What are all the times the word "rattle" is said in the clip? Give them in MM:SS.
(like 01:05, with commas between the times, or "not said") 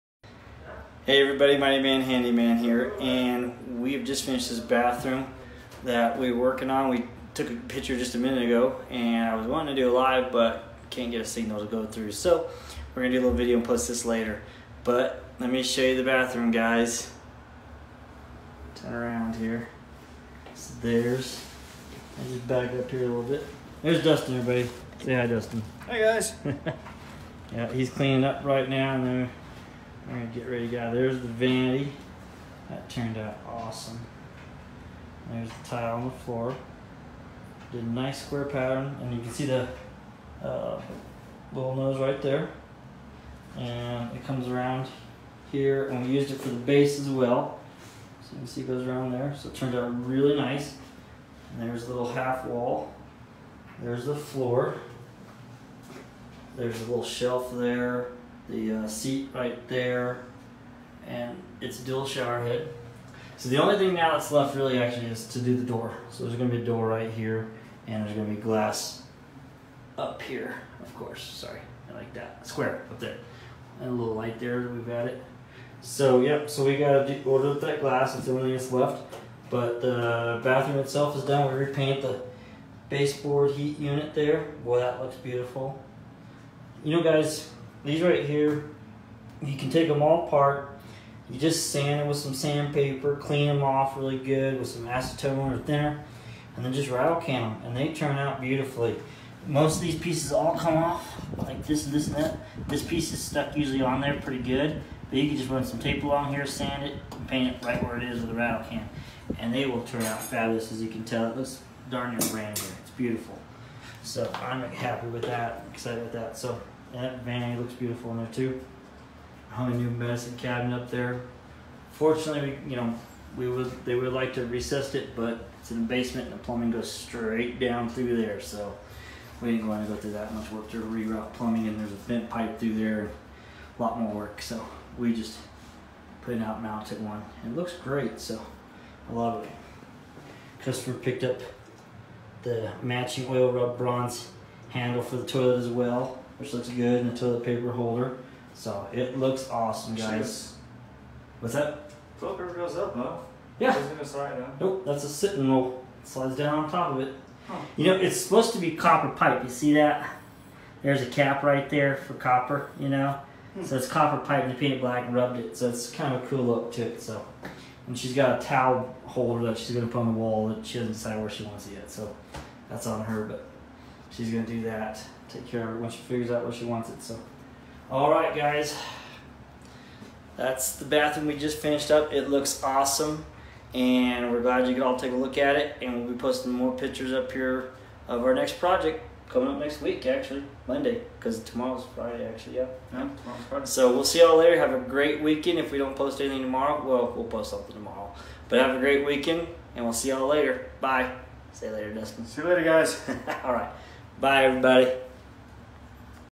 01:36, 01:48.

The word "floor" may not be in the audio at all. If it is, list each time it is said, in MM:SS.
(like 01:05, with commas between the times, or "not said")
00:36, 00:54.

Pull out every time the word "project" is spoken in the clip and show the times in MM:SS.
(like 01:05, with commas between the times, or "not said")
03:08.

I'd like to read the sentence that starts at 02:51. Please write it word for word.
So that's on her, but she's gonna do that.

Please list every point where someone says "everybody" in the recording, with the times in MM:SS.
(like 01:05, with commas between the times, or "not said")
00:01, 00:24, 03:24.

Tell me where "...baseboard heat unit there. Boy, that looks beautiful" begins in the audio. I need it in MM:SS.
01:22.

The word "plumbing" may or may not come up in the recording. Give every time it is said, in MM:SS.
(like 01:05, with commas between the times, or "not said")
02:06, 02:11.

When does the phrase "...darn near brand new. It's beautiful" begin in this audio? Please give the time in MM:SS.
01:51.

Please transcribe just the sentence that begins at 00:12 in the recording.
So we're gonna do a little video and post this later.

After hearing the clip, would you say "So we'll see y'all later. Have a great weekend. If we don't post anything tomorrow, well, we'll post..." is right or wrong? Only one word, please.
right.